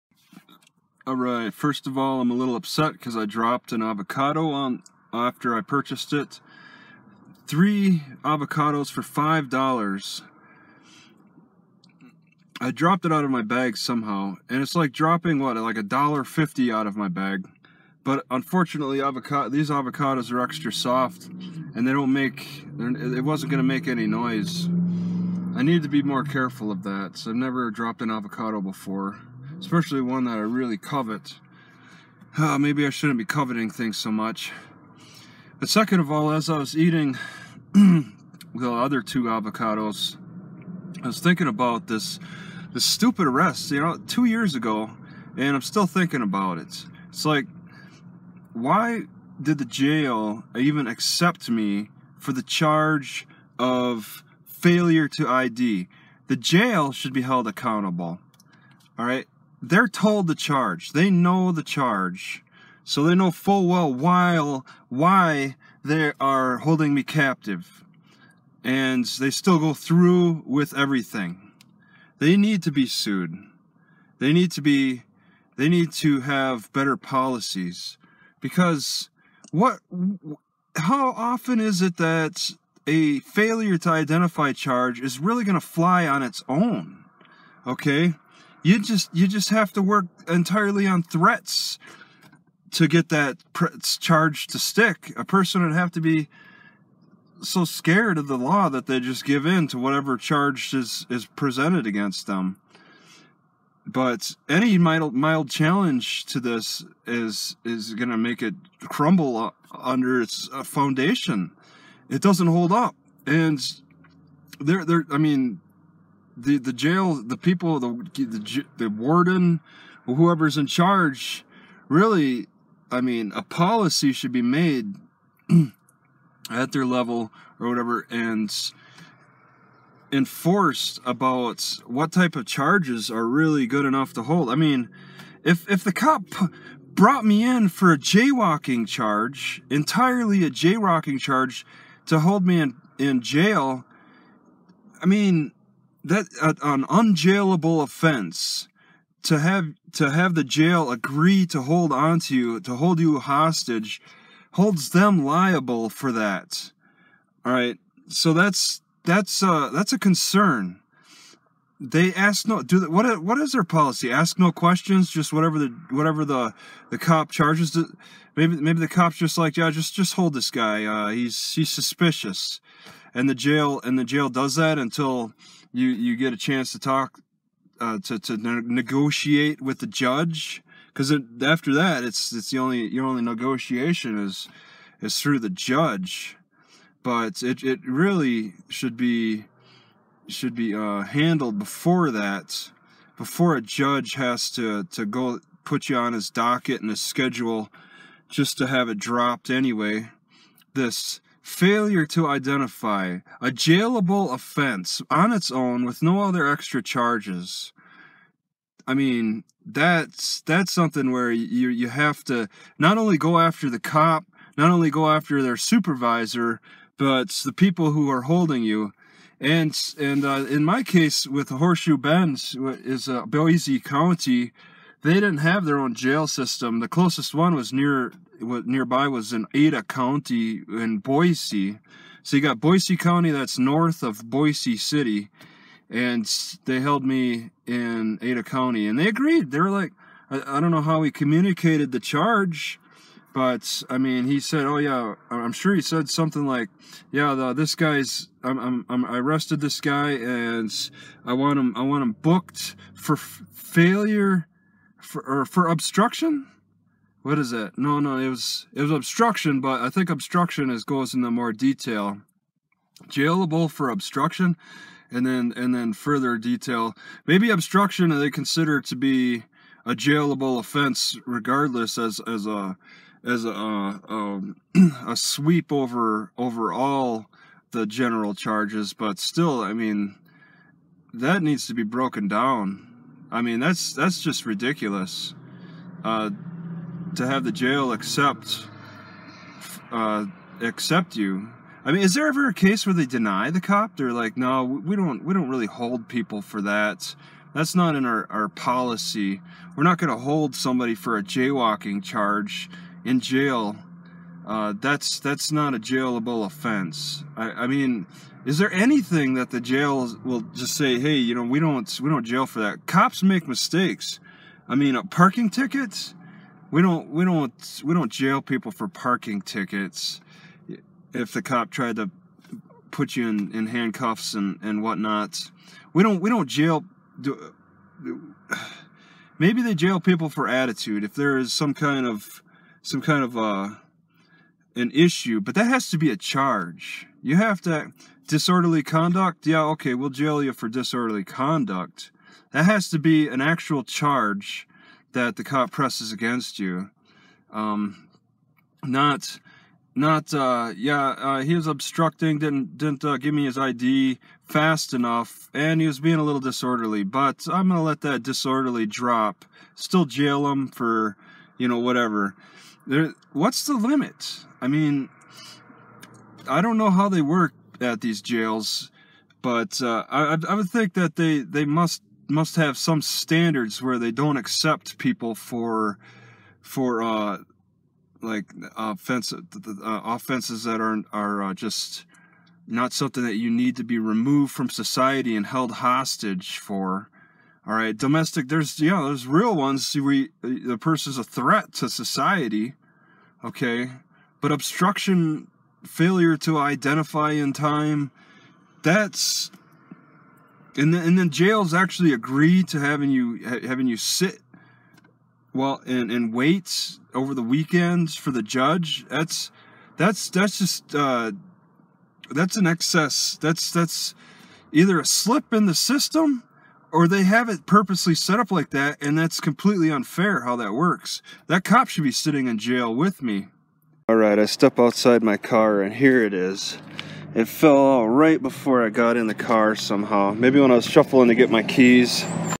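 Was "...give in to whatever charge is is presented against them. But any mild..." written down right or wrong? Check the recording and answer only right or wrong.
right.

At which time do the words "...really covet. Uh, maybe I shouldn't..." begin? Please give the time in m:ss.
0:30.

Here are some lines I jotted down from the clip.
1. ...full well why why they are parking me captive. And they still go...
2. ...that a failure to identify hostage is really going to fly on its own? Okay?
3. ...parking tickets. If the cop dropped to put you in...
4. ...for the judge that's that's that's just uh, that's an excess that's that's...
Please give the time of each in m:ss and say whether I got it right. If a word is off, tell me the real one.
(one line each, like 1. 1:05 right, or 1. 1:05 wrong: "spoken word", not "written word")
1. 1:03 wrong: "holding", not "parking"
2. 1:21 wrong: "charge", not "hostage"
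3. 5:18 wrong: "tried", not "dropped"
4. 6:48 right.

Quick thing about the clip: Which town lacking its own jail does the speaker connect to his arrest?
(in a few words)
Horseshoe Bend.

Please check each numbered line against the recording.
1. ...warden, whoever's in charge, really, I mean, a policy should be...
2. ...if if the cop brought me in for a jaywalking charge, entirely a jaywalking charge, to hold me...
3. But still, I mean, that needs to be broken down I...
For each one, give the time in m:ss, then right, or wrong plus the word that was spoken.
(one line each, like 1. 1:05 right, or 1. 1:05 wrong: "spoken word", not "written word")
1. 1:58 right
2. 2:15 right
3. 4:38 right.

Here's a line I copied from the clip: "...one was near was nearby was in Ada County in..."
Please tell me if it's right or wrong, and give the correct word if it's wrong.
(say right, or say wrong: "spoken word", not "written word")
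right.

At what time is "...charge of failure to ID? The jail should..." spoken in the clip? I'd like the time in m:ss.
0:52.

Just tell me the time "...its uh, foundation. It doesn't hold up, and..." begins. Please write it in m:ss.
1:50.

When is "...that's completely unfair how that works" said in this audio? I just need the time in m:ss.
6:59.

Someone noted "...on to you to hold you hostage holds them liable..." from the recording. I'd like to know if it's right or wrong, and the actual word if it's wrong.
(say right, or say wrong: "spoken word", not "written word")
right.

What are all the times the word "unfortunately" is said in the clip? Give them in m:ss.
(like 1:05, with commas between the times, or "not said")
0:18.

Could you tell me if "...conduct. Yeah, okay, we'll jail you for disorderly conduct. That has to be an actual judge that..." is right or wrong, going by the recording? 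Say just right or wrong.
wrong.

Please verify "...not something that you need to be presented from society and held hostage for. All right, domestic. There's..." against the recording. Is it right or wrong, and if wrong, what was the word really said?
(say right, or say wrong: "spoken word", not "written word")
wrong: "removed", not "presented".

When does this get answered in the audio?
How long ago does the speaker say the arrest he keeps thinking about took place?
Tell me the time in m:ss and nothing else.
0:44.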